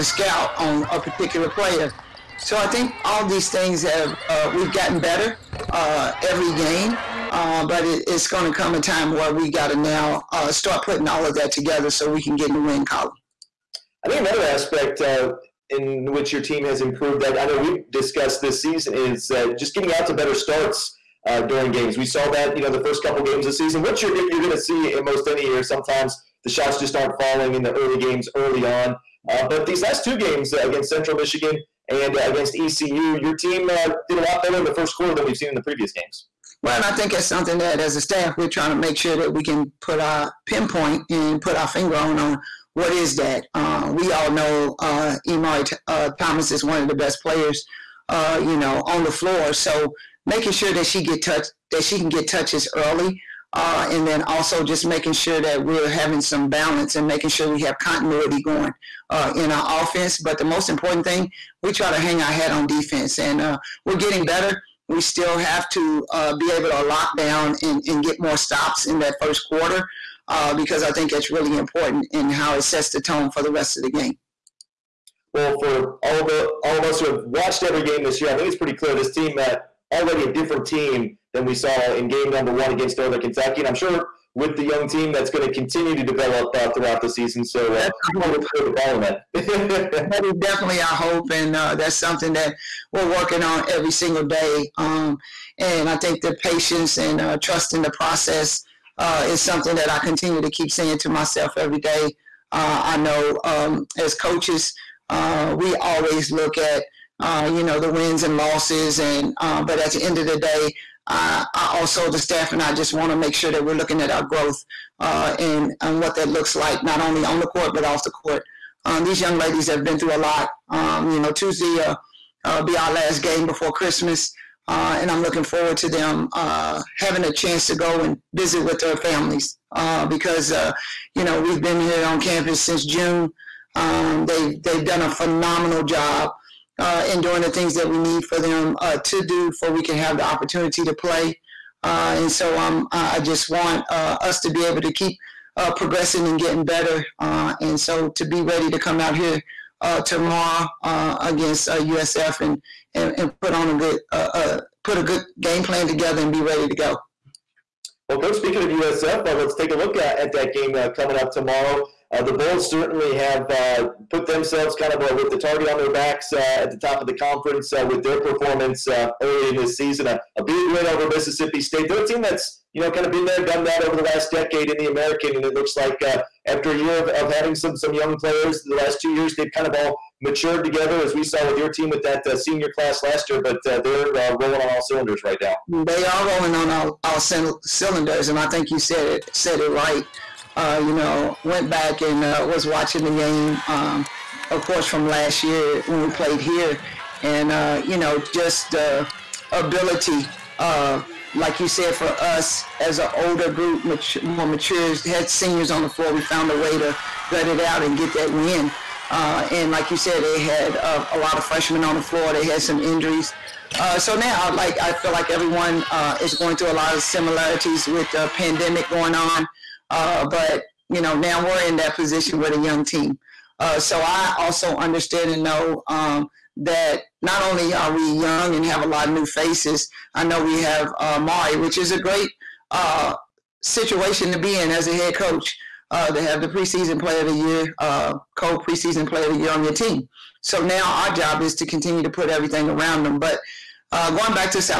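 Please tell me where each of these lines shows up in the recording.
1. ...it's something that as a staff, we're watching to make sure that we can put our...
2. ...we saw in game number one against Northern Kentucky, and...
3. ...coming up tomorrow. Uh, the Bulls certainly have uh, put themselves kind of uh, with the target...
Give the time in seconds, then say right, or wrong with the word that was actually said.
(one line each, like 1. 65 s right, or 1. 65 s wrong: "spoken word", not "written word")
1. 37 s wrong: "trying", not "watching"
2. 81 s right
3. 160 s right.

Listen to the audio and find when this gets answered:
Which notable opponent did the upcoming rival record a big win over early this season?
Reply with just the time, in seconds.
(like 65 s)
171 s.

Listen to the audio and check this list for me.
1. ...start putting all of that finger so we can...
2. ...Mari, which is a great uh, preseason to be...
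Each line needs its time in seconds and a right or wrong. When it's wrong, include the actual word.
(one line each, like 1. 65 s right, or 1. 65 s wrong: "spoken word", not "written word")
1. 10 s wrong: "together", not "finger"
2. 231 s wrong: "situation", not "preseason".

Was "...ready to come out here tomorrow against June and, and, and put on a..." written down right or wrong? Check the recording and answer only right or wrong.
wrong.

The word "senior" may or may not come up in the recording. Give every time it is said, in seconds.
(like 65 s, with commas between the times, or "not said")
182 s, 205 s.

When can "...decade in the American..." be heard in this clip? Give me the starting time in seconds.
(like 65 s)
174 s.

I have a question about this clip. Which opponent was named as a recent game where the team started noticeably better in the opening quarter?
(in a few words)
Central Michigan.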